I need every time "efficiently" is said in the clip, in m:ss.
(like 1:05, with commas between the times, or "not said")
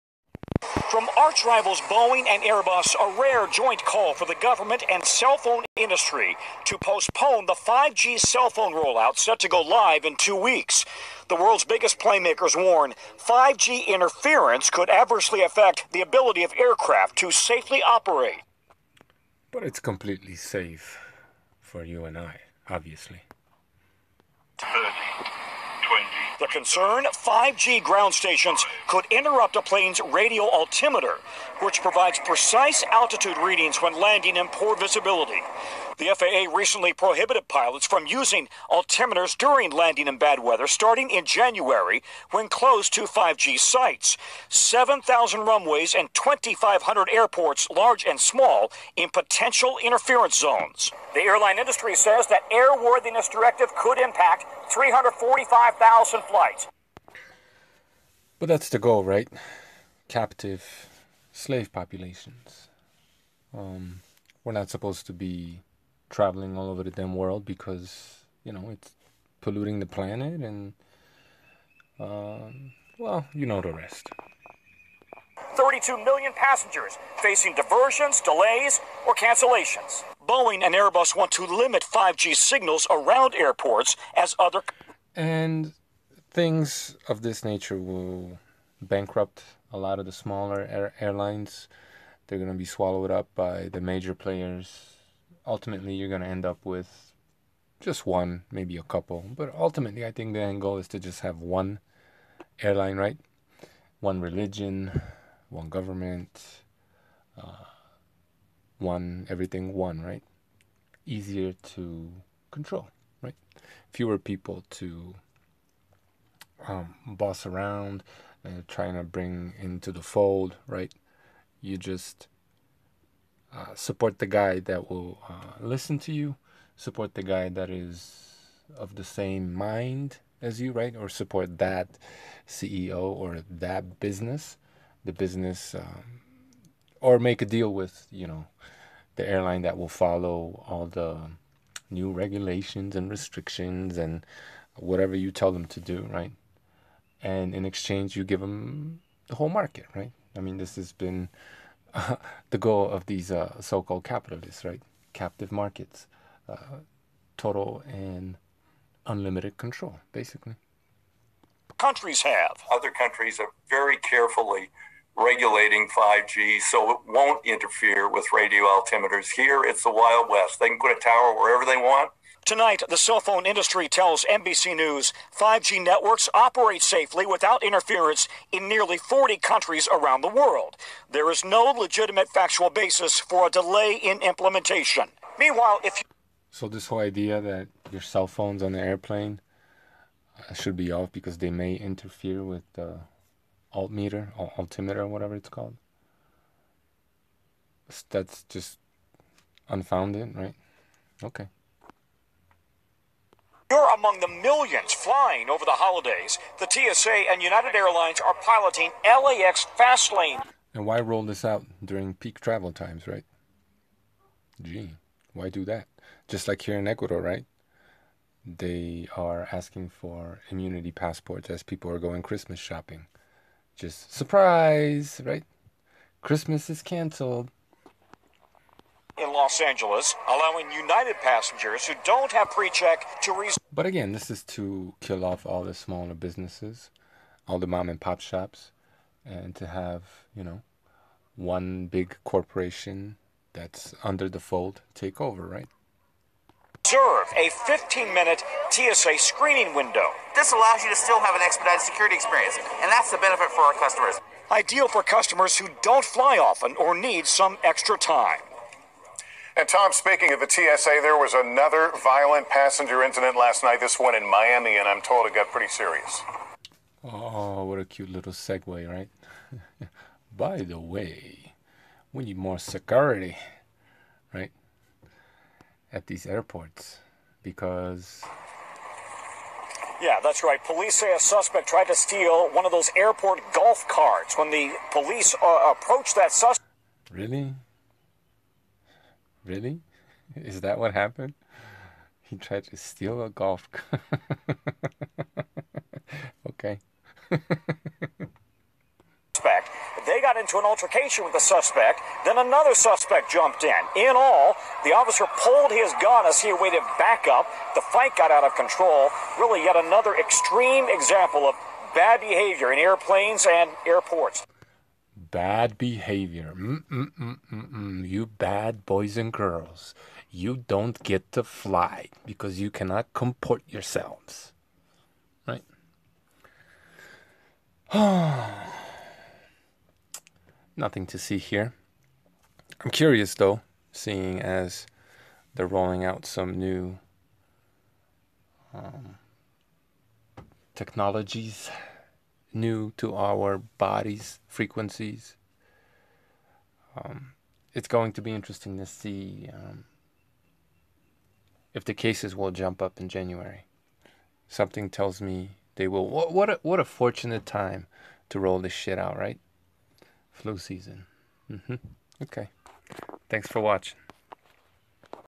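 not said.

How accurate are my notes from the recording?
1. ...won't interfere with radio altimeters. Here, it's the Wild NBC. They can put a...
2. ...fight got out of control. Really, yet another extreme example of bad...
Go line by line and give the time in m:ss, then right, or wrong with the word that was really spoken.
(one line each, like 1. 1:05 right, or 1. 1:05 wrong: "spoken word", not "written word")
1. 2:47 wrong: "West", not "NBC"
2. 5:07 right.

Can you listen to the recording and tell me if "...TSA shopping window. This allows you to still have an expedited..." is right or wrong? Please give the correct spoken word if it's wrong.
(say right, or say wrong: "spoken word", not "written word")
wrong: "screening", not "shopping".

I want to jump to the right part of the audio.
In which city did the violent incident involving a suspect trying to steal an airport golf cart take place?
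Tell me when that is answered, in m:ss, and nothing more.
4:24.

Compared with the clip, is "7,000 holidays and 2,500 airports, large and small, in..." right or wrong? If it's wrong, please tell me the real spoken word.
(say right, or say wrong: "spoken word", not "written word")
wrong: "runways", not "holidays".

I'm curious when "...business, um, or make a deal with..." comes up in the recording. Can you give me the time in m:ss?
2:15.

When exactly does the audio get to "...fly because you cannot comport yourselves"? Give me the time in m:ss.
5:21.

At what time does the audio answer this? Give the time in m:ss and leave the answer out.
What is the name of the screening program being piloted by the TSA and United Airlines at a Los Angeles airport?
3:29.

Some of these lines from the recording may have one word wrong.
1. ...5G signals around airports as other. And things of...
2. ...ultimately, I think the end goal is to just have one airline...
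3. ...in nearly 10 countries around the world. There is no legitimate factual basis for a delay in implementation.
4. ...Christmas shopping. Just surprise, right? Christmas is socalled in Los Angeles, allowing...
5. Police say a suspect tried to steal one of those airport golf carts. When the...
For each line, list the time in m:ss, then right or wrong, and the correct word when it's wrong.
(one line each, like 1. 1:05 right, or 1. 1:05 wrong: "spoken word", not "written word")
1. 1:21 right
2. 1:39 right
3. 2:58 wrong: "40", not "10"
4. 3:42 wrong: "canceled", not "socalled"
5. 4:40 right.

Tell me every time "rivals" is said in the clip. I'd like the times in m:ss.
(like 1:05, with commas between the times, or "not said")
0:01.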